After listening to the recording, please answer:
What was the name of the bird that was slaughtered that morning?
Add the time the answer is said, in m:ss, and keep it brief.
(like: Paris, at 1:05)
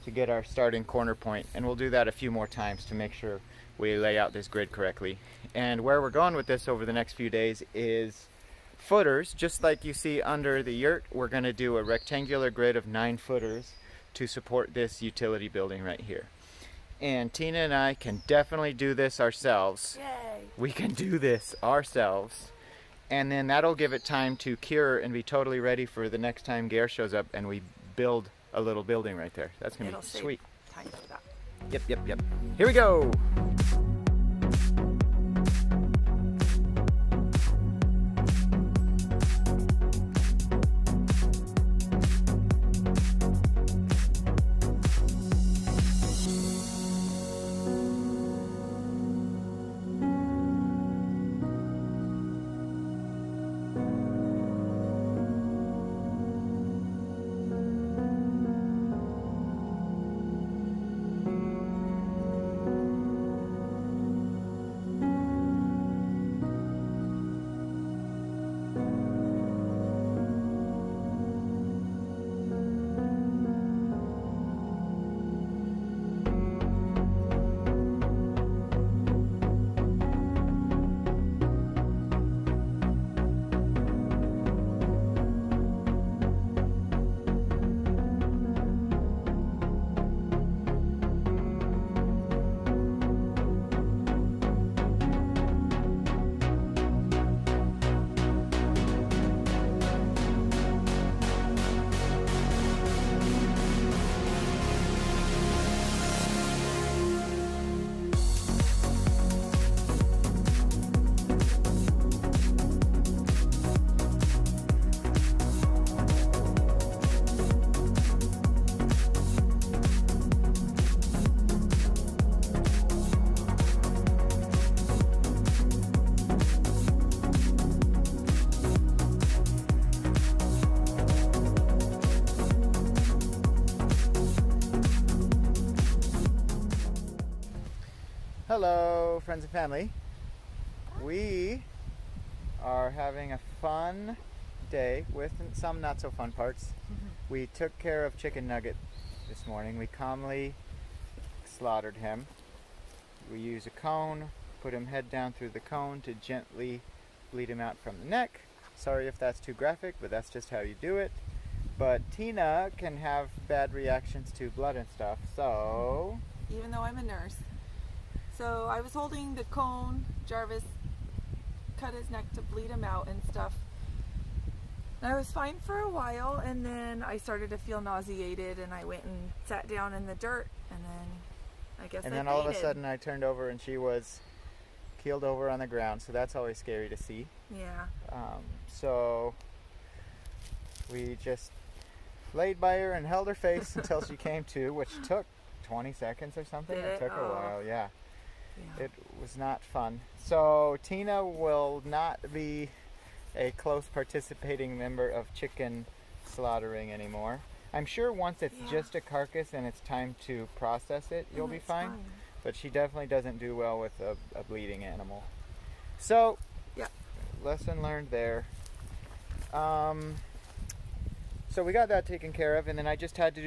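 Chicken Nugget, at 2:28.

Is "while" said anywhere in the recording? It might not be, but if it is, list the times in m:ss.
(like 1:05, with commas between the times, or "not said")
2:55, 3:17.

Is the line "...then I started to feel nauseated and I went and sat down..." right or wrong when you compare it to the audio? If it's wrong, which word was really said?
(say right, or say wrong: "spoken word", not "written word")
right.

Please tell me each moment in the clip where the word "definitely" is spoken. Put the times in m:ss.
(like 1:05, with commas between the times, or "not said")
0:18, 3:32.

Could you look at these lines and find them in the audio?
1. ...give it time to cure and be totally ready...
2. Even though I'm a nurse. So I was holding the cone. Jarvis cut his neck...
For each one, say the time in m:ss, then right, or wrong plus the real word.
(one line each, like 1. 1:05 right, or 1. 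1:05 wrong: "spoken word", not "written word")
1. 0:23 right
2. 2:46 right.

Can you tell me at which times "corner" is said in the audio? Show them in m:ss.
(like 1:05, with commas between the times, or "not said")
0:00.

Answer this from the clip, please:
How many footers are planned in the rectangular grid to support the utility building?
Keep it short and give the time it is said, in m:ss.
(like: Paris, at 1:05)
9, at 0:12.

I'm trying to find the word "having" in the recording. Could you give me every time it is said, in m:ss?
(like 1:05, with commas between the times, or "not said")
2:22.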